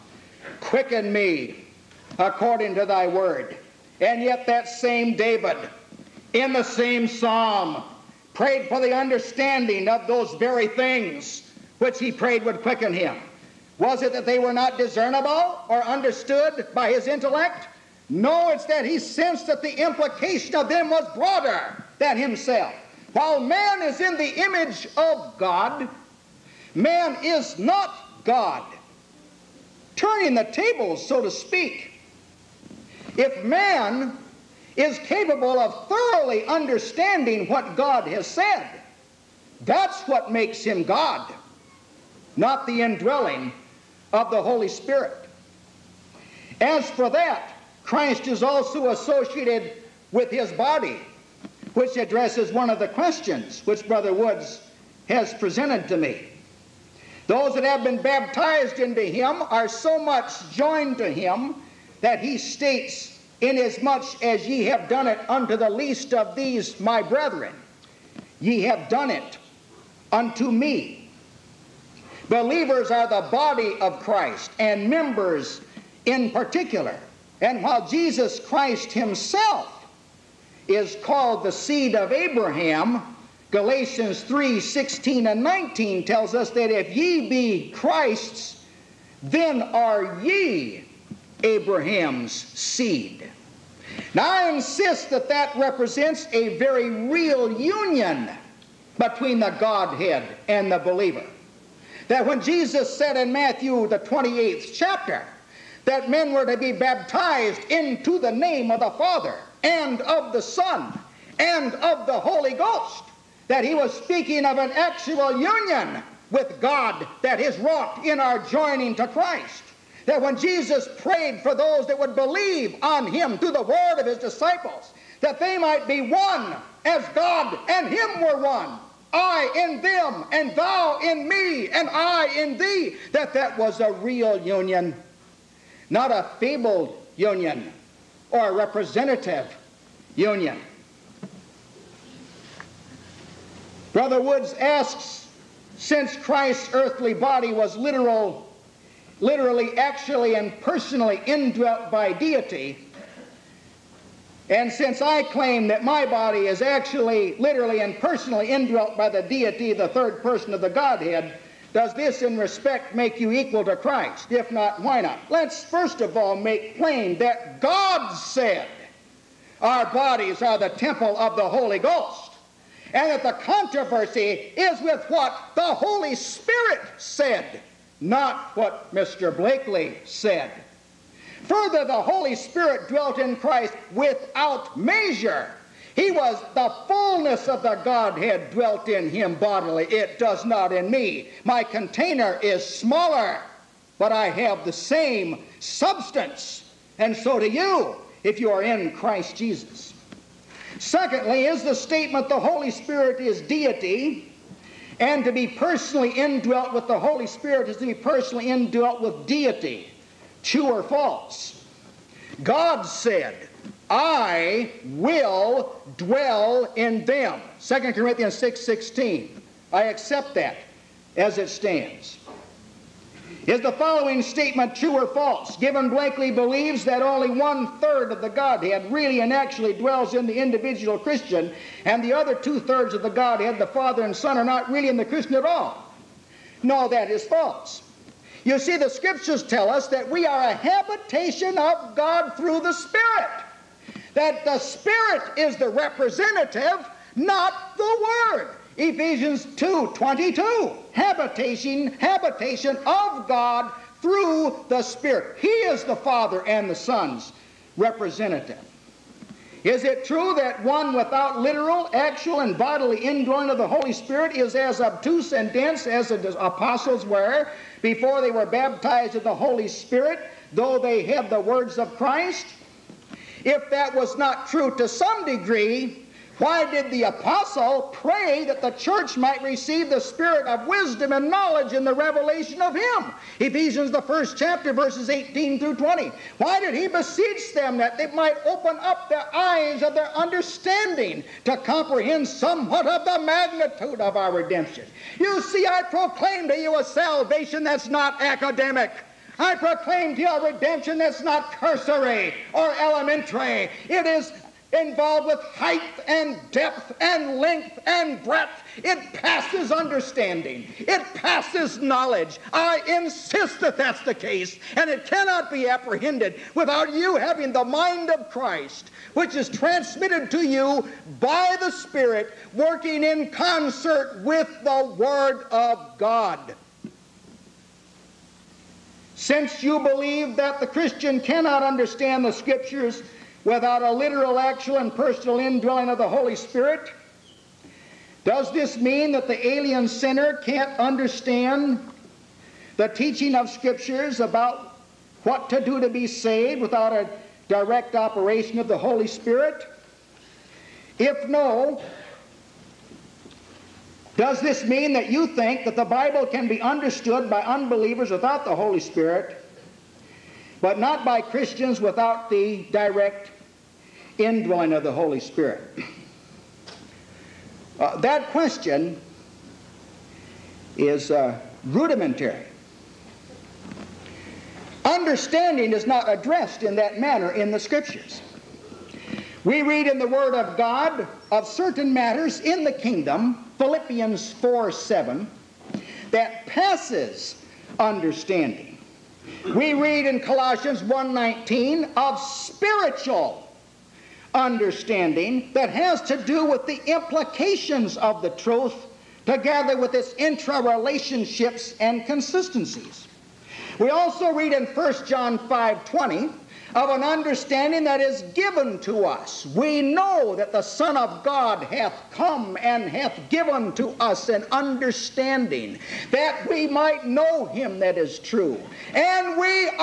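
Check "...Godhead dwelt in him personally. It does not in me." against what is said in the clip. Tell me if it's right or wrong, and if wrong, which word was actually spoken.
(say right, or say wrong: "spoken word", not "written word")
wrong: "bodily", not "personally".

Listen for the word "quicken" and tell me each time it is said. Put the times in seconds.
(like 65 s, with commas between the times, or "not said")
0 s, 12 s.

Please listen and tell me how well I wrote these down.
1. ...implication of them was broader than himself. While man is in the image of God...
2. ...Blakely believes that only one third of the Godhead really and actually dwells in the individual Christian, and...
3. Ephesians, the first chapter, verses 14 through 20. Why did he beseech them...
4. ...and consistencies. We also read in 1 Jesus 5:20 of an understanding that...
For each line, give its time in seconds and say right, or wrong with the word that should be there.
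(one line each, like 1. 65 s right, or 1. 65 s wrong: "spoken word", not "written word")
1. 19 s right
2. 225 s right
3. 283 s wrong: "18", not "14"
4. 401 s wrong: "John", not "Jesus".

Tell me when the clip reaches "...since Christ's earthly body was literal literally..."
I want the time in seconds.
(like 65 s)
145 s.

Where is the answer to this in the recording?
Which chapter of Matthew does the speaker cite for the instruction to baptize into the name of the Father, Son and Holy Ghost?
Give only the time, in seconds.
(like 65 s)
103 s.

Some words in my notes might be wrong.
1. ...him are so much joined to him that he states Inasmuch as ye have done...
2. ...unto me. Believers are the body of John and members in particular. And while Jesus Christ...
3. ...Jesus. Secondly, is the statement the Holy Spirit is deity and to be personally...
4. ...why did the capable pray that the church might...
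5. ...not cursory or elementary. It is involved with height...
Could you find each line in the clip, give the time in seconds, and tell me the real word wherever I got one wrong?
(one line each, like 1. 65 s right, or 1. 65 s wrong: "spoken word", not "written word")
1. 59 s right
2. 70 s wrong: "Christ", not "John"
3. 199 s right
4. 276 s wrong: "apostle", not "capable"
5. 301 s right.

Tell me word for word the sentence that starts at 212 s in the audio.
God said, I will dwell in them.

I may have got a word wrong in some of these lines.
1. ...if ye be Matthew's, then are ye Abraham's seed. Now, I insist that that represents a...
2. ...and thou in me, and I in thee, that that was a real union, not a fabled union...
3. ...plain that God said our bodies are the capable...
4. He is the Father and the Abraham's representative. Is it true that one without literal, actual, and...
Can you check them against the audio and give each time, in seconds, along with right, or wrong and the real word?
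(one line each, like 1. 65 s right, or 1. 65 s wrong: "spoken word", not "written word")
1. 86 s wrong: "Christ", not "Matthew"
2. 130 s right
3. 166 s wrong: "temple", not "capable"
4. 255 s wrong: "Son", not "Abraham".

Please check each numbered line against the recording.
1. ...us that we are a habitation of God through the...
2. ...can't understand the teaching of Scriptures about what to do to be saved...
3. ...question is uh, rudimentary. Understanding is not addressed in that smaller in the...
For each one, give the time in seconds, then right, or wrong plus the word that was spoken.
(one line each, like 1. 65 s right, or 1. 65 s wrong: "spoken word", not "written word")
1. 239 s right
2. 340 s right
3. 368 s wrong: "manner", not "smaller".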